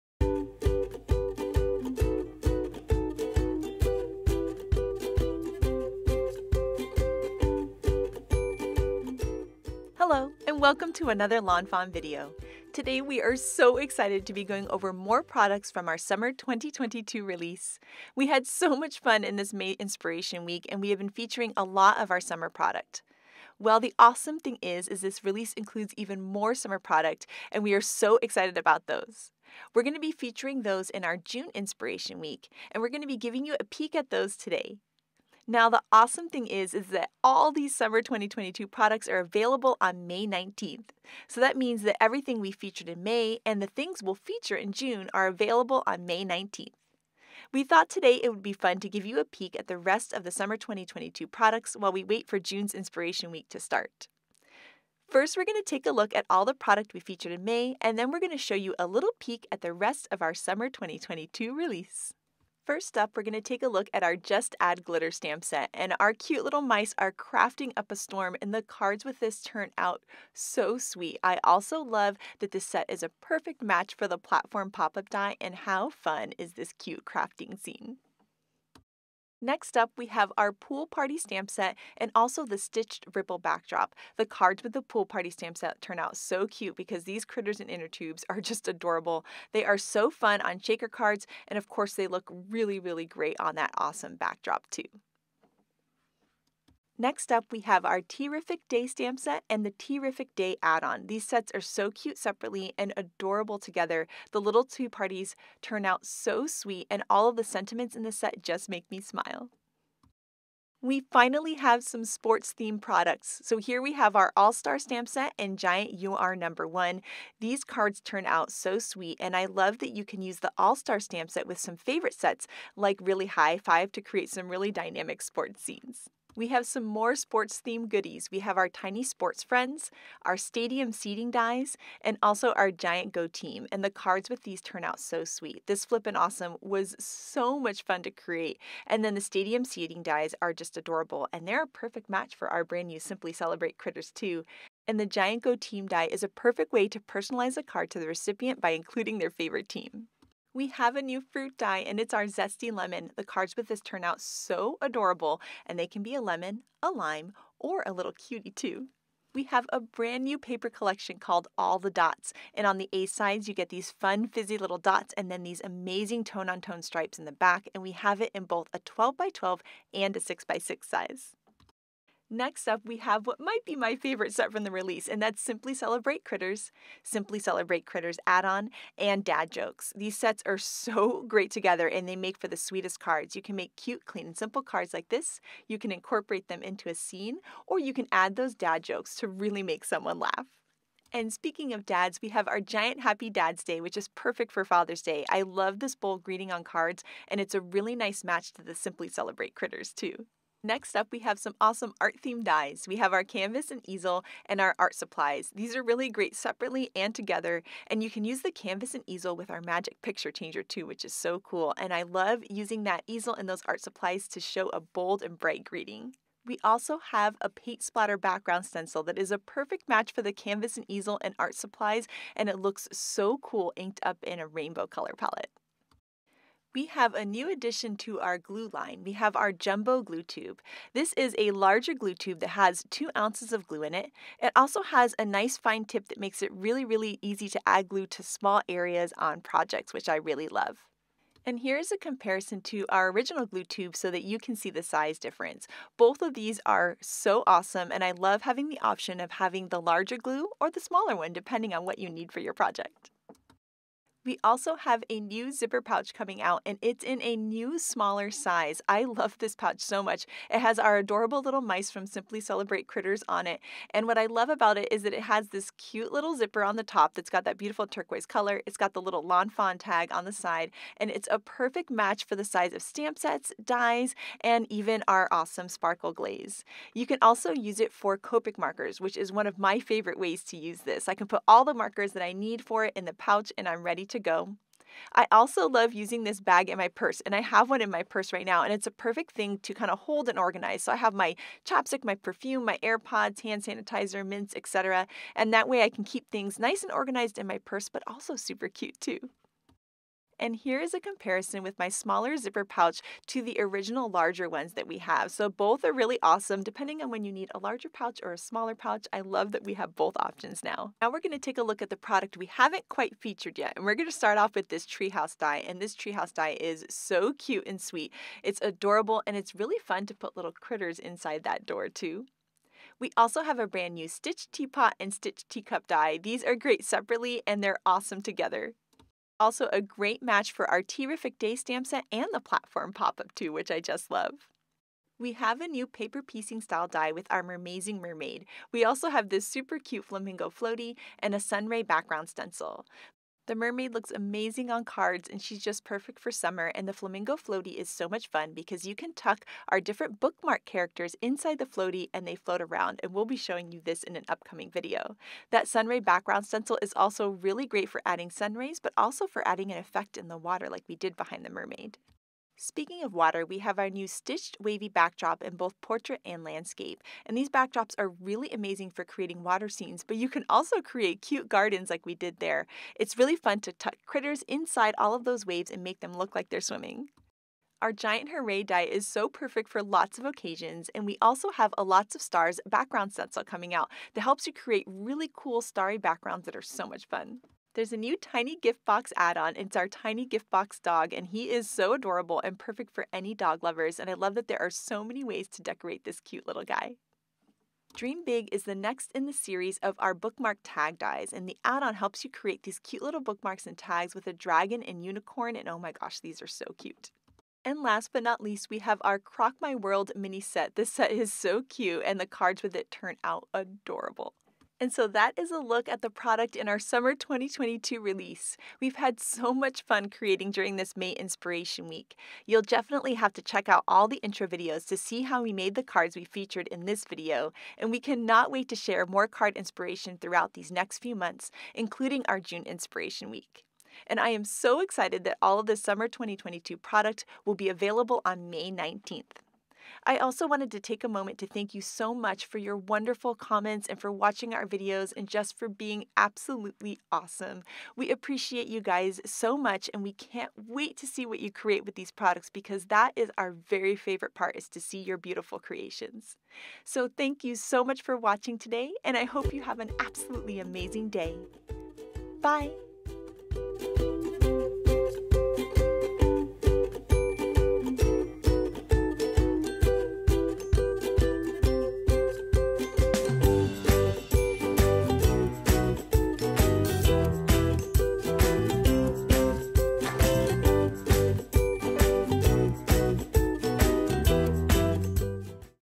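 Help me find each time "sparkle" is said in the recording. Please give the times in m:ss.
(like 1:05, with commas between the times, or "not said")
4:35.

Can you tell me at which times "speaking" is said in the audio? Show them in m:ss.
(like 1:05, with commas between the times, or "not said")
3:11, 6:02.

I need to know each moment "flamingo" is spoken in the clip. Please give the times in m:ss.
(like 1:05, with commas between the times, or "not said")
5:40, 5:46.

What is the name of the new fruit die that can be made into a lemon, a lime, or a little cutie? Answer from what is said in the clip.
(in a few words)
zesty lemon.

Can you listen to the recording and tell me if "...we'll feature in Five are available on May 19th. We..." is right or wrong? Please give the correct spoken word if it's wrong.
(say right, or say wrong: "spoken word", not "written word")
wrong: "June", not "Five".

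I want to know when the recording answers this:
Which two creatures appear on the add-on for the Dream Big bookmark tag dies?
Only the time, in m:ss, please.
6:44.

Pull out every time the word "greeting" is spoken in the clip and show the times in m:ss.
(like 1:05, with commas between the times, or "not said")
3:16, 3:35.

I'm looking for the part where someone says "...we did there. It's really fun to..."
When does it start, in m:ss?
6:12.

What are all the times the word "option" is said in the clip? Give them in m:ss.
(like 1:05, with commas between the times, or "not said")
4:08, 5:10.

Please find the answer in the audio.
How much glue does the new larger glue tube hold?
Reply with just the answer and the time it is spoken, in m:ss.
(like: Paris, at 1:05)
2 ounces, at 3:52.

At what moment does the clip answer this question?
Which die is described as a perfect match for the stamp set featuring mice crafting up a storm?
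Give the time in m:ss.
1:14.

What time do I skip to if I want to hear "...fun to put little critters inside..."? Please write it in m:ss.
5:19.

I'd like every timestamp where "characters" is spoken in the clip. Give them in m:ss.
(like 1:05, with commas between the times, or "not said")
5:50.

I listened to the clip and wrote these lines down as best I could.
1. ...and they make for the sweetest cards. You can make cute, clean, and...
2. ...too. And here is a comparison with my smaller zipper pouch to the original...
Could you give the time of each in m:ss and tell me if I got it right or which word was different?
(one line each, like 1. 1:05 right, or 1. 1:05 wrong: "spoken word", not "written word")
1. 3:01 right
2. 4:59 right.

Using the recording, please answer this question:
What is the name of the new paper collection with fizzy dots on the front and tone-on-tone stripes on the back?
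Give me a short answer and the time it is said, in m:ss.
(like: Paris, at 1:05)
All the Dots, at 2:41.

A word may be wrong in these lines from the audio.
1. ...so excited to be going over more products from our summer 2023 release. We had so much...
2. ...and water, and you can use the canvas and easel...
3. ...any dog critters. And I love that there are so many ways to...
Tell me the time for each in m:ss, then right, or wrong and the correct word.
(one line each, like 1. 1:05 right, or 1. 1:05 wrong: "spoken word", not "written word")
1. 0:13 wrong: "2022", not "2023"
2. 3:26 wrong: "together", not "water"
3. 6:33 wrong: "lovers", not "critters".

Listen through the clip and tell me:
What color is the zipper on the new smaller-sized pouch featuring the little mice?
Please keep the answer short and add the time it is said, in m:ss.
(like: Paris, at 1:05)
turquoise, at 4:27.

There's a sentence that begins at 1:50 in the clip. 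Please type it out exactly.
We finally have some sports themed products.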